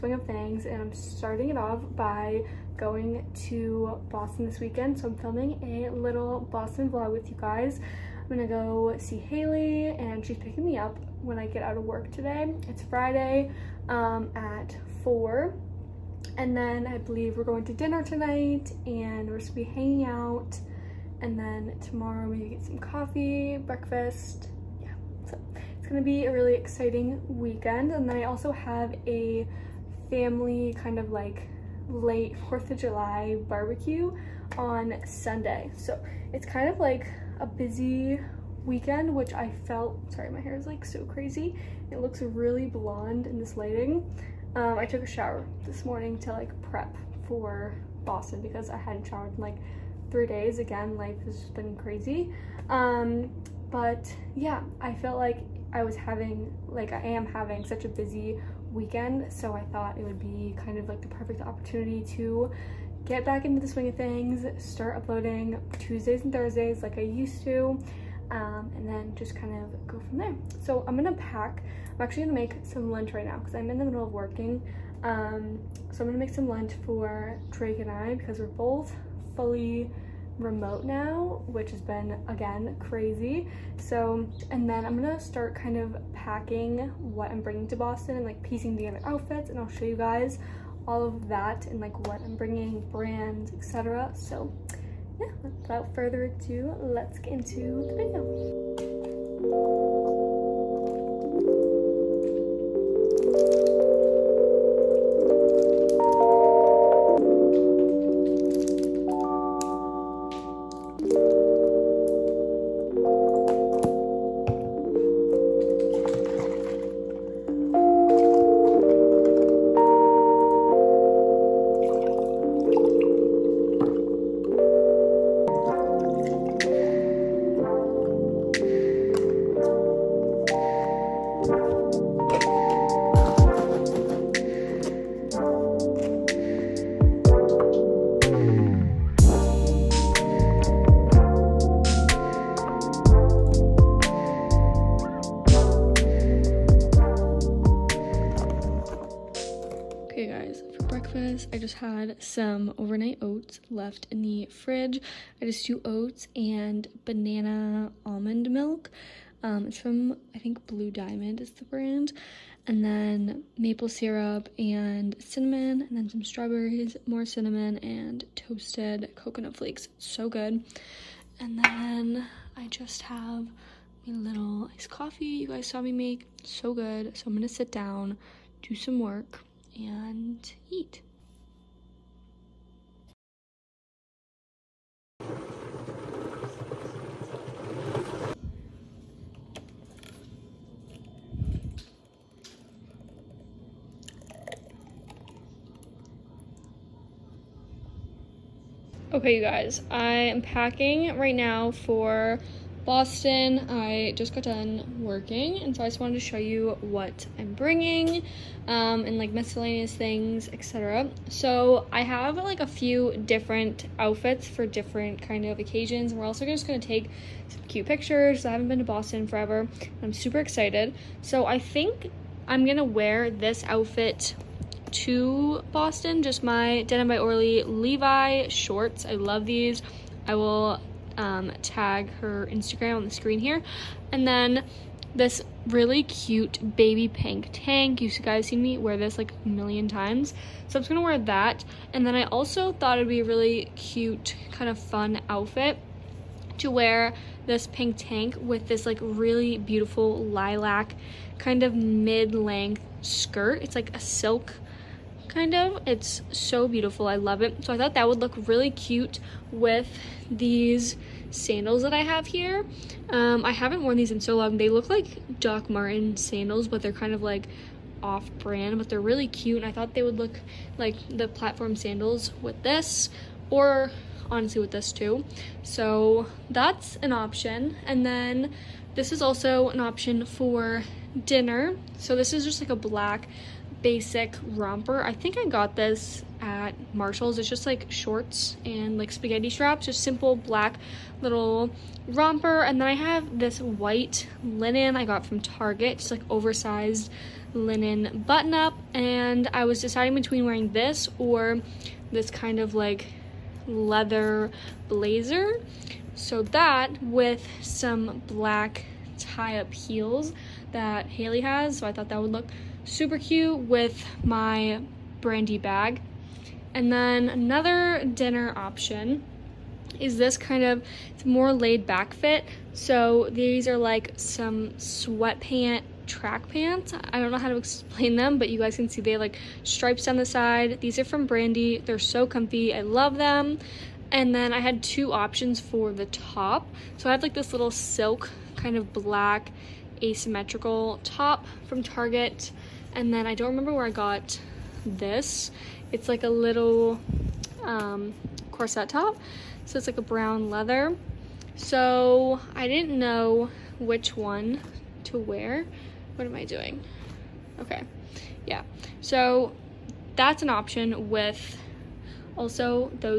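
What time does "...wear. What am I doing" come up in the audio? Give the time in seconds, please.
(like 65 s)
355 s.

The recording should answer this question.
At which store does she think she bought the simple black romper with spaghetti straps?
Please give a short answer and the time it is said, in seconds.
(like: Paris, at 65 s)
Marshall's, at 286 s.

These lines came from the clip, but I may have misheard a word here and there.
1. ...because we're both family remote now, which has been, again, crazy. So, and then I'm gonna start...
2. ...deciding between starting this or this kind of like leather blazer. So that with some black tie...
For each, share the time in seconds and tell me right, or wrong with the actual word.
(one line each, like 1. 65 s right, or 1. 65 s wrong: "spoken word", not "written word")
1. 78 s wrong: "fully", not "family"
2. 299 s wrong: "wearing", not "starting".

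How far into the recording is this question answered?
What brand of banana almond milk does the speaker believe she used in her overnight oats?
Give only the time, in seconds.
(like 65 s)
160 s.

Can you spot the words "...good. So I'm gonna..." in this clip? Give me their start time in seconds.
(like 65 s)
176 s.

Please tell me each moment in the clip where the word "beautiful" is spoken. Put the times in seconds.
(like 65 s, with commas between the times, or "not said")
249 s, 256 s.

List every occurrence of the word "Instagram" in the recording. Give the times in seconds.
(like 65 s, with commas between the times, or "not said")
232 s.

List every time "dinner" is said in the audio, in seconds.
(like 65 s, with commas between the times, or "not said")
17 s, 281 s, 318 s.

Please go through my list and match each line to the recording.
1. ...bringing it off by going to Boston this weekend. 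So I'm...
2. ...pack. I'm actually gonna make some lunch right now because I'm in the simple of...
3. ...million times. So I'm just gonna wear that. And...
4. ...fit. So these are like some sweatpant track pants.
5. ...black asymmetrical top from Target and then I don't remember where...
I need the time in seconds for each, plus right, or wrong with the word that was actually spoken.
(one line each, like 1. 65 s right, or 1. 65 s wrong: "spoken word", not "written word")
1. 0 s wrong: "starting", not "bringing"
2. 71 s wrong: "middle", not "simple"
3. 239 s right
4. 322 s right
5. 338 s right.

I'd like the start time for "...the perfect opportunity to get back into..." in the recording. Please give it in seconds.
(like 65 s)
61 s.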